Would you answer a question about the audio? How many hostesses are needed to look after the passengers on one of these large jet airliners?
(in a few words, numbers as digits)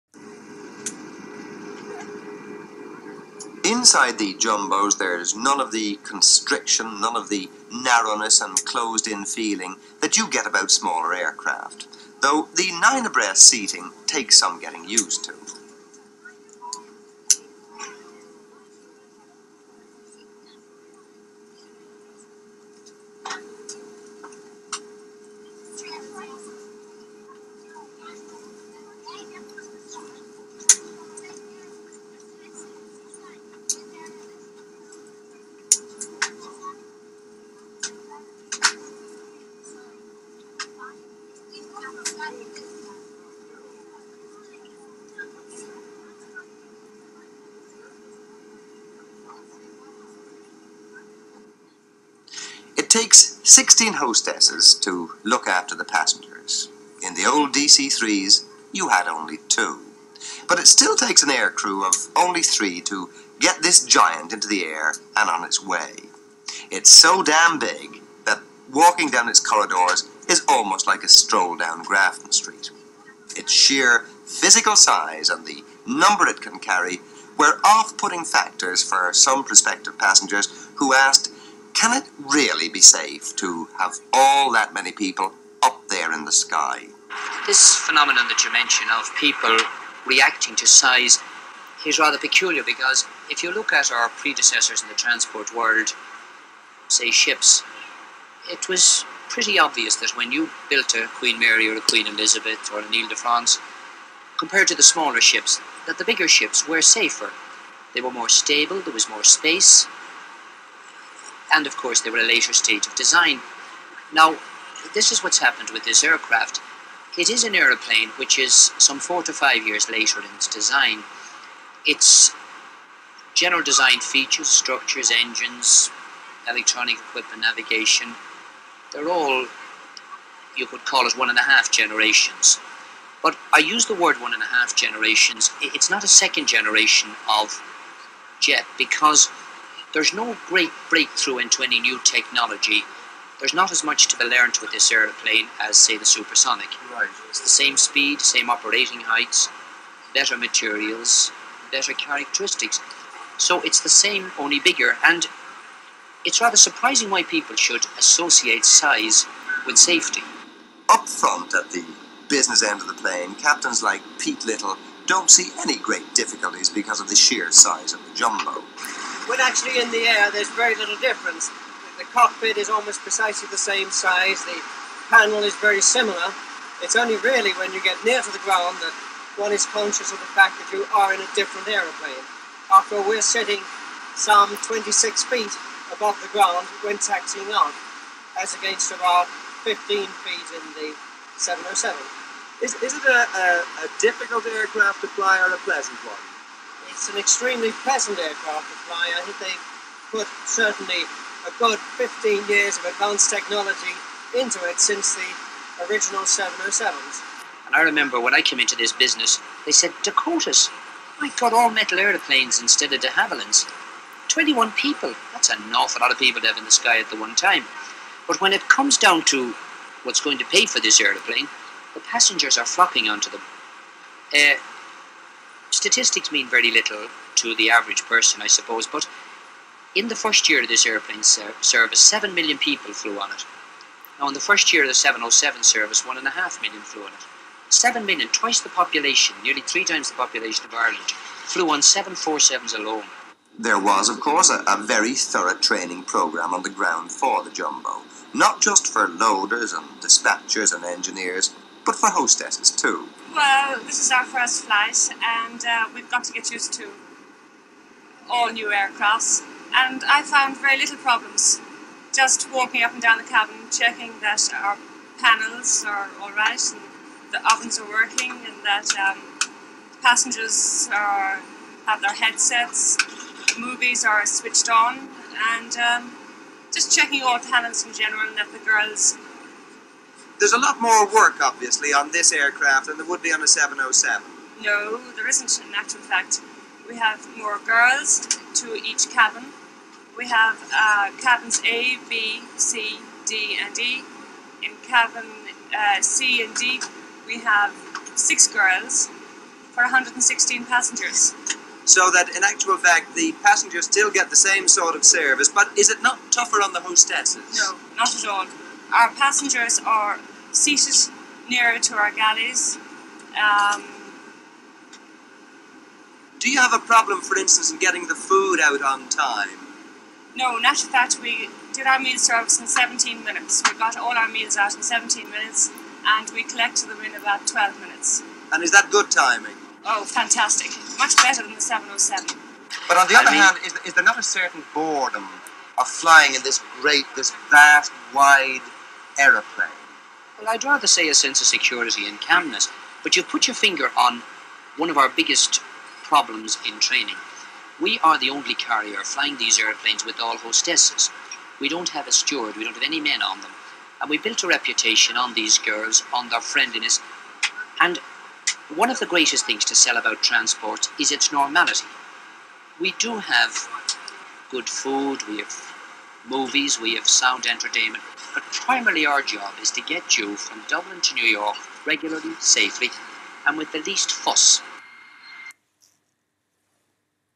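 16.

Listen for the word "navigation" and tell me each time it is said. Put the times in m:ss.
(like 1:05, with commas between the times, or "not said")
2:07.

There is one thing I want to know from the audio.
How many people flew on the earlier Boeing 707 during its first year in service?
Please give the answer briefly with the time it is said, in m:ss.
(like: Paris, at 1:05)
1.5 million, at 3:56.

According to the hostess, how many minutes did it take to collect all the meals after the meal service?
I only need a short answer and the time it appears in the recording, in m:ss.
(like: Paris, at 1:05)
12 minutes, at 5:27.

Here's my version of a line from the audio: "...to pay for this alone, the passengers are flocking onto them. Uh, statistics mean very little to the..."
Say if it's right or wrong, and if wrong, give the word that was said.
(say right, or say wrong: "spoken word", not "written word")
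wrong: "airplane", not "alone".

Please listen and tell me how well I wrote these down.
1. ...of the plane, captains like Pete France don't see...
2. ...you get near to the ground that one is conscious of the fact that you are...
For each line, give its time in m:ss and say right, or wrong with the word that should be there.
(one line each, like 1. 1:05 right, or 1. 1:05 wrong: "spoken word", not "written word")
1. 2:42 wrong: "Little", not "France"
2. 2:57 right.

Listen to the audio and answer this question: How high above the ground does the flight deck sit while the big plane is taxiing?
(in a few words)
26 feet.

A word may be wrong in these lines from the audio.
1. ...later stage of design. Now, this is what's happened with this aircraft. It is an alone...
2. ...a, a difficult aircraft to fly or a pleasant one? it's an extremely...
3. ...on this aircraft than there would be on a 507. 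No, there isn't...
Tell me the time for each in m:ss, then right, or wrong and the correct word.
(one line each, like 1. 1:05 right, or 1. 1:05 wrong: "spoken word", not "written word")
1. 1:52 wrong: "aeroplane", not "alone"
2. 3:13 right
3. 4:41 wrong: "707", not "507".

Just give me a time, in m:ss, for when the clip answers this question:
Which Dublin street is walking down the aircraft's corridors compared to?
1:11.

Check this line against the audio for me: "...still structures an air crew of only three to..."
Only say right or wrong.
wrong.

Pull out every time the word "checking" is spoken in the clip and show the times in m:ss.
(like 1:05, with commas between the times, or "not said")
4:23, 4:36.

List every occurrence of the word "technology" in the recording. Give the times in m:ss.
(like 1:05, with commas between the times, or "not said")
2:22, 3:23.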